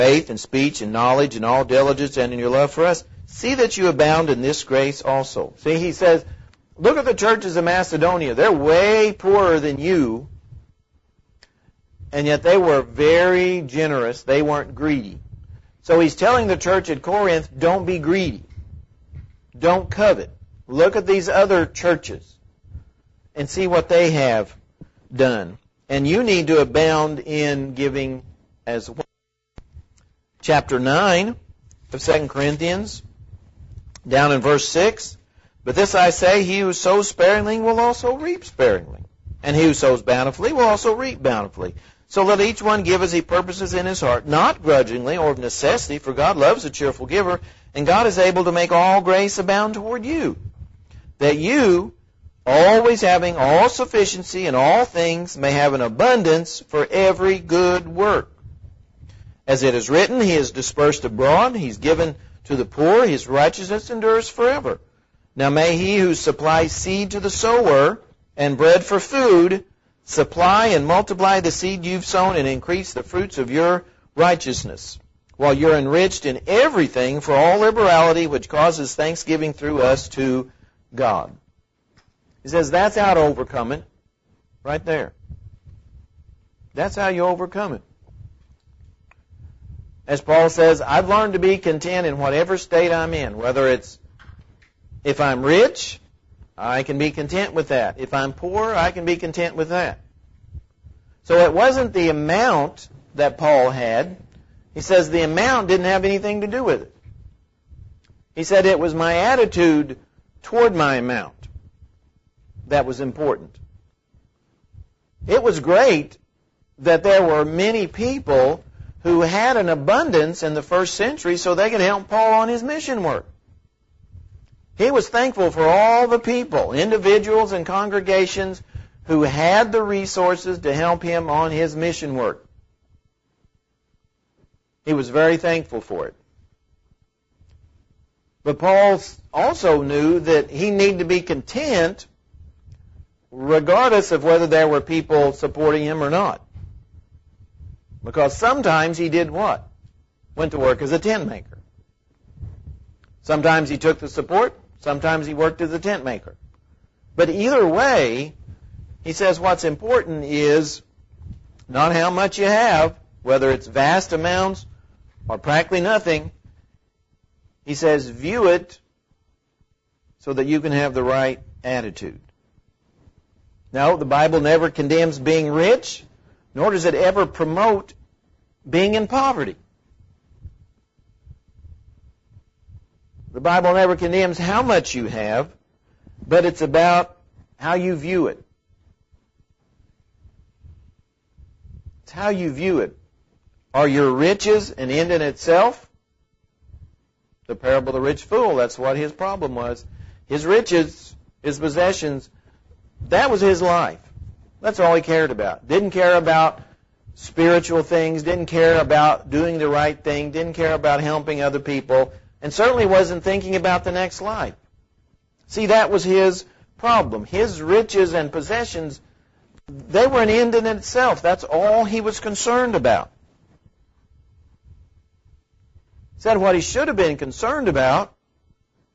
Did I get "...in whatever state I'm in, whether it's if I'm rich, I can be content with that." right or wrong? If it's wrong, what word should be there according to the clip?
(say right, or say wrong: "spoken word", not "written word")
right.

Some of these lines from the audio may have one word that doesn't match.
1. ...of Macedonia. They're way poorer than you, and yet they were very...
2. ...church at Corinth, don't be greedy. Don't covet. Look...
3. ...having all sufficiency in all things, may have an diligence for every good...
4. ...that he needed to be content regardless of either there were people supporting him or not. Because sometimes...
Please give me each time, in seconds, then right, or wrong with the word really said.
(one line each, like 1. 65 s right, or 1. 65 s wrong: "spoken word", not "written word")
1. 7 s right
2. 16 s right
3. 53 s wrong: "abundance", not "diligence"
4. 140 s wrong: "whether", not "either".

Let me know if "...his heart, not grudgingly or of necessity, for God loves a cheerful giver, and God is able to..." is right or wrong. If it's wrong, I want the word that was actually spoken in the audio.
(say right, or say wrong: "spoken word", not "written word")
right.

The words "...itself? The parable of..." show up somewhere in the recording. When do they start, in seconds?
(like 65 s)
195 s.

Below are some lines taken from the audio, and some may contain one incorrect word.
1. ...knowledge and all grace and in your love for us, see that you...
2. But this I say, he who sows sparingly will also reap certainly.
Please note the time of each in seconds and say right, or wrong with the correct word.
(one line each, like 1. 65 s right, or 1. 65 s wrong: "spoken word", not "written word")
1. 0 s wrong: "diligence", not "grace"
2. 35 s wrong: "sparingly", not "certainly".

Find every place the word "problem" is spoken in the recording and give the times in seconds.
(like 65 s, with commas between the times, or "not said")
199 s, 216 s.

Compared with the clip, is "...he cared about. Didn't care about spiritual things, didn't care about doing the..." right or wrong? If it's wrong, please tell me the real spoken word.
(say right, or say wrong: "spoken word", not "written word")
right.